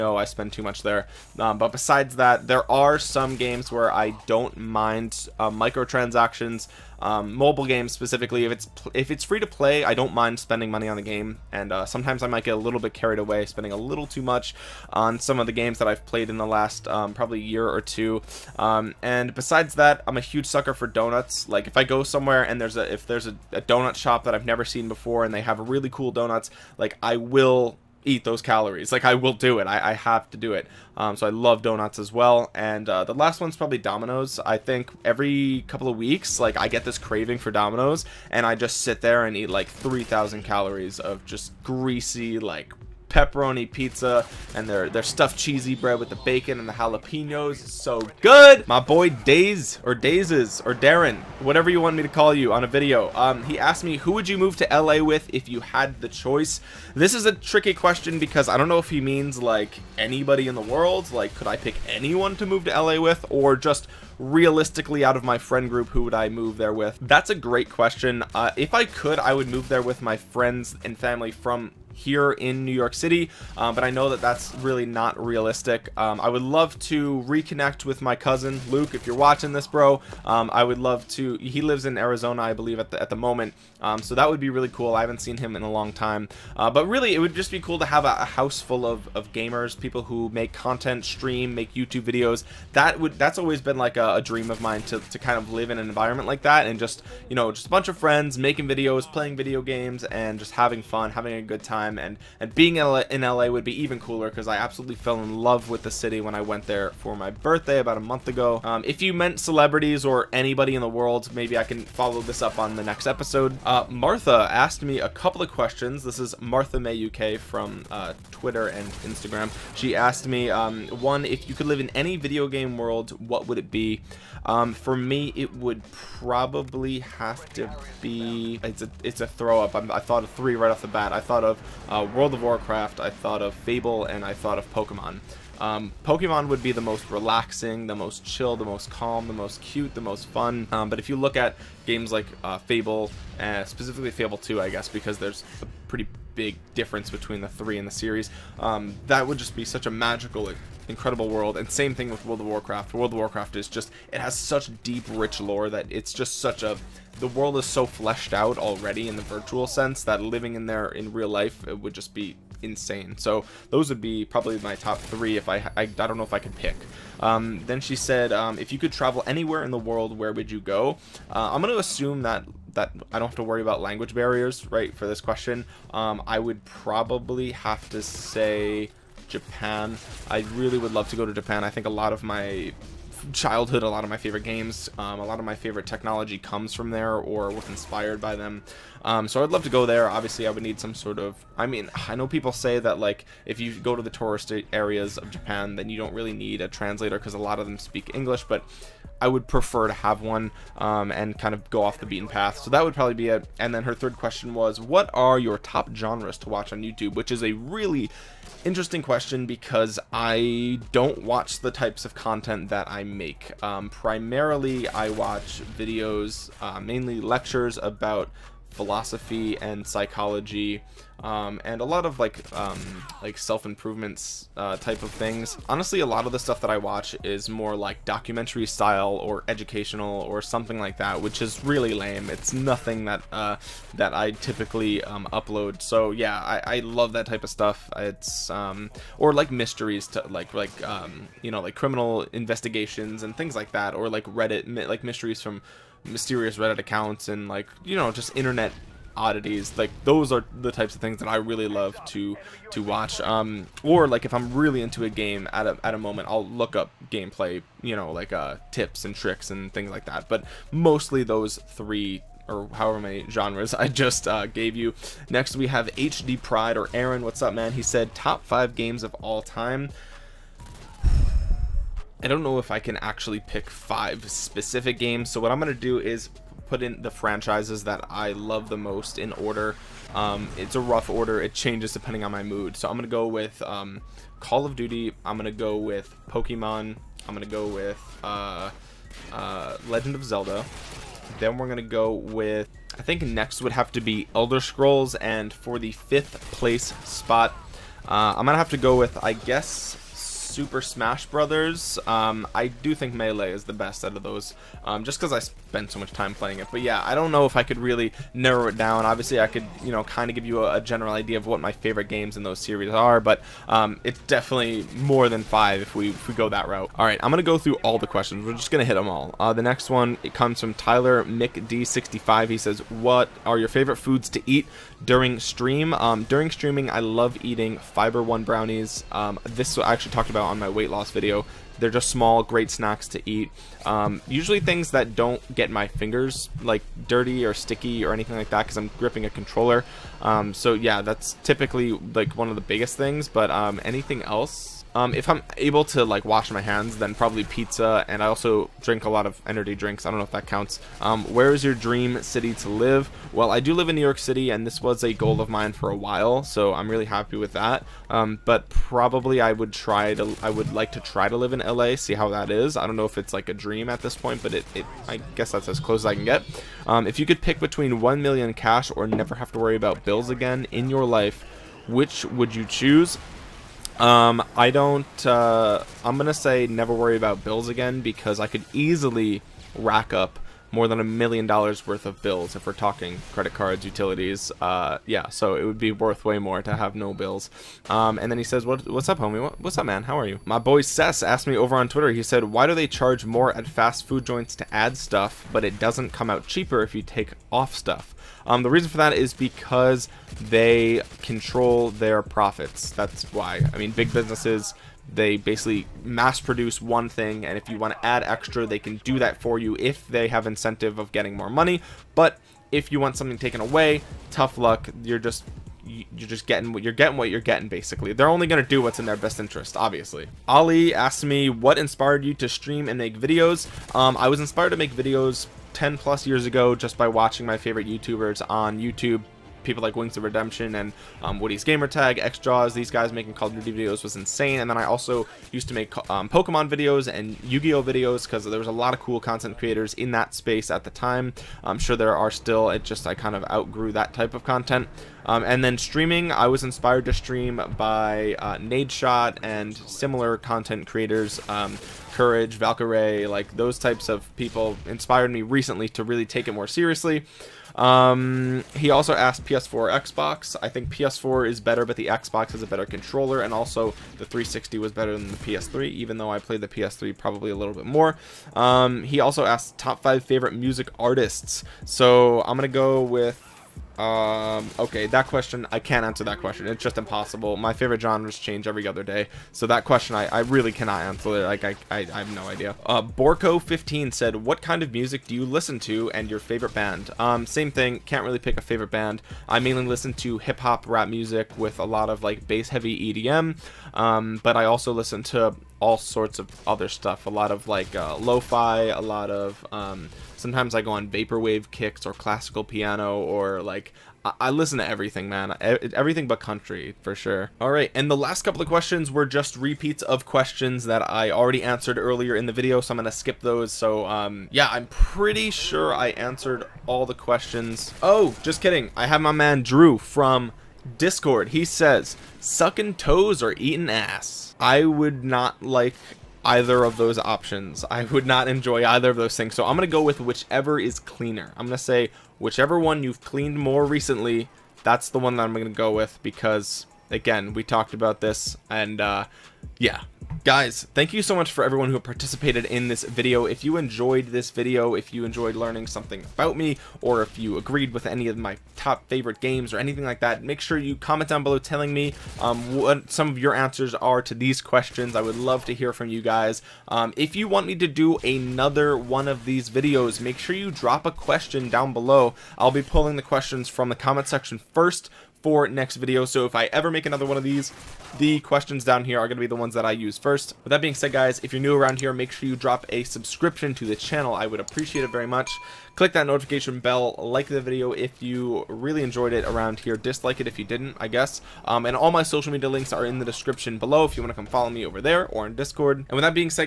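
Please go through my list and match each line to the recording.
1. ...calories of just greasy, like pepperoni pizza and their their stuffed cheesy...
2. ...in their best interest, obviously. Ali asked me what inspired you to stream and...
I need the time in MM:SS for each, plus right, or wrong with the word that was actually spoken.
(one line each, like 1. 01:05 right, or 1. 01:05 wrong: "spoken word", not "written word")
1. 00:40 right
2. 06:58 right.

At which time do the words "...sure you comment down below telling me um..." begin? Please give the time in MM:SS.
09:10.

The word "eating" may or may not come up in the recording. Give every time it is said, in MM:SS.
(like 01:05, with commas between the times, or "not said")
05:27, 08:43.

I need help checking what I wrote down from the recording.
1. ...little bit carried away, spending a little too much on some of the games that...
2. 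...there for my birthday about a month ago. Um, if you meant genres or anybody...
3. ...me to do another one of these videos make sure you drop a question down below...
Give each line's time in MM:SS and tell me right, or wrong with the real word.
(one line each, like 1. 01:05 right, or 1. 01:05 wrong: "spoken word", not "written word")
1. 00:12 right
2. 01:46 wrong: "celebrities", not "genres"
3. 09:17 right.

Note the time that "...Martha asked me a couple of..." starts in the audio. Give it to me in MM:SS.
01:53.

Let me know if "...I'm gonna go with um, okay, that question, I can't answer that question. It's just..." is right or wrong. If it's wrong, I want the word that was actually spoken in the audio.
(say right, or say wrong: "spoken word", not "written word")
right.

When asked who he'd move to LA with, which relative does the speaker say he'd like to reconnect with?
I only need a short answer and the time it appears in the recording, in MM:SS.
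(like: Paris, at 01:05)
Luke, at 01:18.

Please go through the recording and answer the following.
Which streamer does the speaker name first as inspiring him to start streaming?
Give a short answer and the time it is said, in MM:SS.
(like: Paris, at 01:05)
Nadeshot, at 07:28.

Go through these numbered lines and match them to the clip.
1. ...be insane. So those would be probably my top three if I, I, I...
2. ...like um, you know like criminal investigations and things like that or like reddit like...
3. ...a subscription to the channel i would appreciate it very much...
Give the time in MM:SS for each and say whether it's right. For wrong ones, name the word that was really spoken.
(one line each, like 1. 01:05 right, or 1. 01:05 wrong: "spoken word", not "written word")
1. 02:42 right
2. 04:00 right
3. 09:32 right.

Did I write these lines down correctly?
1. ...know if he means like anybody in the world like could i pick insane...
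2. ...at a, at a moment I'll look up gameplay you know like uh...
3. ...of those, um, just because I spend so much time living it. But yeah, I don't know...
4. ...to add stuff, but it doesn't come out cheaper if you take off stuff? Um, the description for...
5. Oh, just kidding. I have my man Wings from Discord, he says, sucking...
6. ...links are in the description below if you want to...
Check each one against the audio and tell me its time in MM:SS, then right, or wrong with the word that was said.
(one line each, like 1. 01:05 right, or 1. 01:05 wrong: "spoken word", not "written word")
1. 00:58 wrong: "anyone", not "insane"
2. 04:15 right
3. 05:04 wrong: "playing", not "living"
4. 06:34 wrong: "reason", not "description"
5. 08:38 wrong: "Drew", not "Wings"
6. 09:42 right.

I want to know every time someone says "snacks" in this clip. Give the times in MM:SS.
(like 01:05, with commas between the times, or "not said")
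05:32.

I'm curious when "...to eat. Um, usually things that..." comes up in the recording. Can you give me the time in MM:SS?
05:33.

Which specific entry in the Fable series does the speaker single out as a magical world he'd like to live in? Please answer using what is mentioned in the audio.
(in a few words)
Fable 2.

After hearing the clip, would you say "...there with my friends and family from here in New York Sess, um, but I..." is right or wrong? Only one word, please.
wrong.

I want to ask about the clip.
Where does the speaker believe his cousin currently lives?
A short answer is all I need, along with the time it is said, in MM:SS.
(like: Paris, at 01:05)
Arizona, at 01:21.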